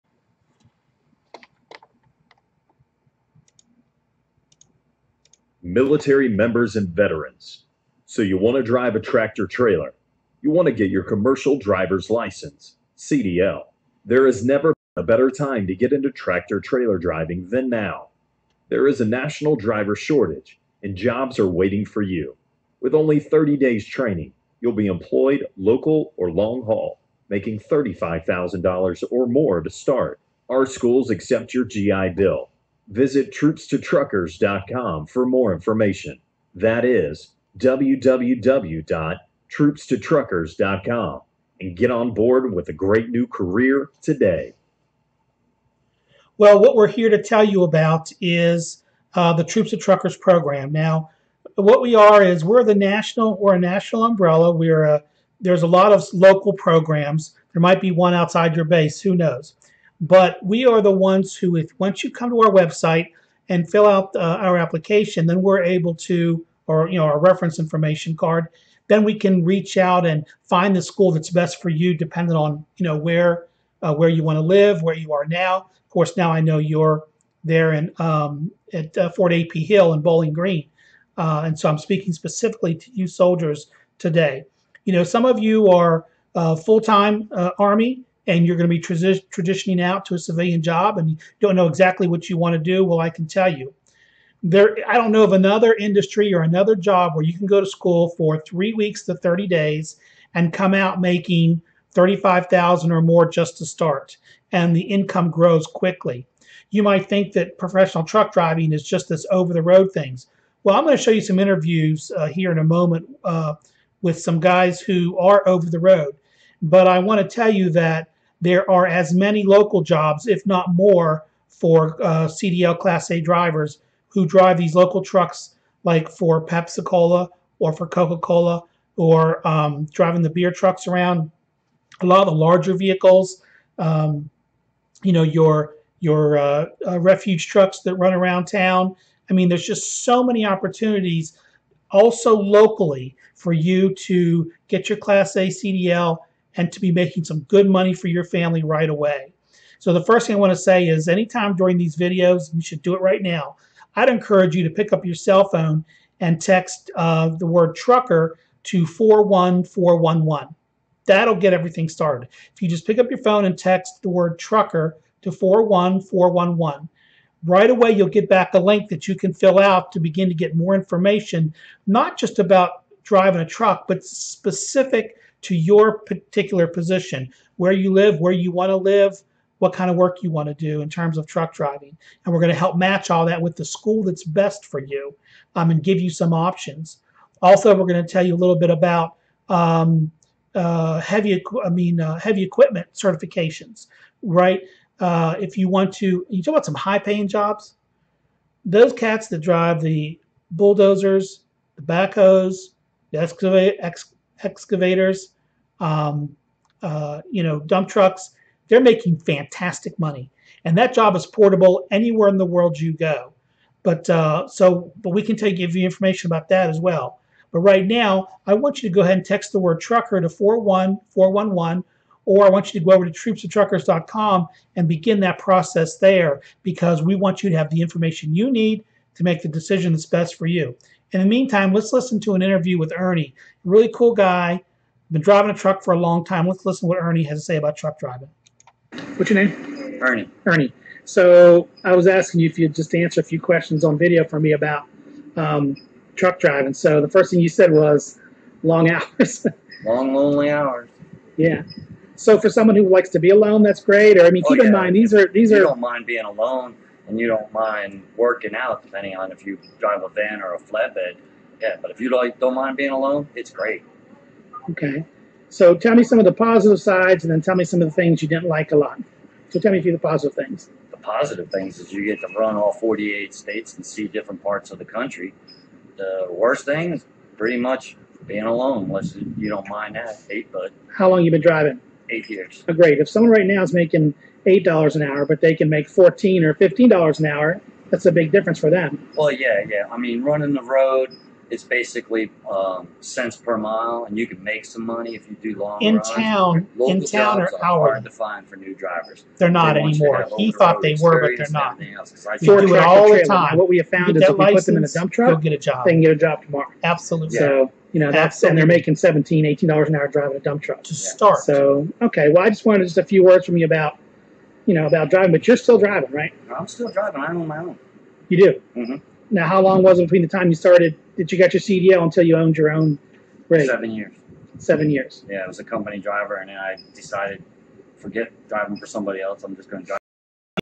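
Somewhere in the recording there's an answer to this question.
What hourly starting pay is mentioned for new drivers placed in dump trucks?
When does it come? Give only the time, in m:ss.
5:08.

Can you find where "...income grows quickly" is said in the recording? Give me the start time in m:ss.
1:44.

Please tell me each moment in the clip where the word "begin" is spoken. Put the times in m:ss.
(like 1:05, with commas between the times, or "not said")
2:49, 3:44.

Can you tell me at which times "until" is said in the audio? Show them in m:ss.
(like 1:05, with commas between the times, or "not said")
5:22.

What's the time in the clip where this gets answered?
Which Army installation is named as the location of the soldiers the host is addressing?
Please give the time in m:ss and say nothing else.
1:19.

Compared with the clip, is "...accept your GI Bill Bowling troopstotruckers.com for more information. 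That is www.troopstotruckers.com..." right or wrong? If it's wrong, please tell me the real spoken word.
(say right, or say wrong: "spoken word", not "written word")
wrong: "Visit", not "Bowling".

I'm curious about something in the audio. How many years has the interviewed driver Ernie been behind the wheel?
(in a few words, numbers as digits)
8 years.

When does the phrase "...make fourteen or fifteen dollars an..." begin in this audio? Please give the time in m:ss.
4:45.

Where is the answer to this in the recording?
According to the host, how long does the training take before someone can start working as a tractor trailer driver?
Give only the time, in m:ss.
0:23.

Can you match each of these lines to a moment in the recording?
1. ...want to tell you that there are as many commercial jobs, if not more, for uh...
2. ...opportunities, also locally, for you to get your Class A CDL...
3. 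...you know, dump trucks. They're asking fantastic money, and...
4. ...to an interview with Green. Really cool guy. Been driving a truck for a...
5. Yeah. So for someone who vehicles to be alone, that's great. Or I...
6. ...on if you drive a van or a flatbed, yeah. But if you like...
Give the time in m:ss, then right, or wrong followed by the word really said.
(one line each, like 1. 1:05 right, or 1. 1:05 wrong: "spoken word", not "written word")
1. 1:56 wrong: "local", not "commercial"
2. 2:20 right
3. 3:27 wrong: "making", not "asking"
4. 3:52 wrong: "Ernie", not "Green"
5. 4:11 wrong: "likes", not "vehicles"
6. 4:19 right.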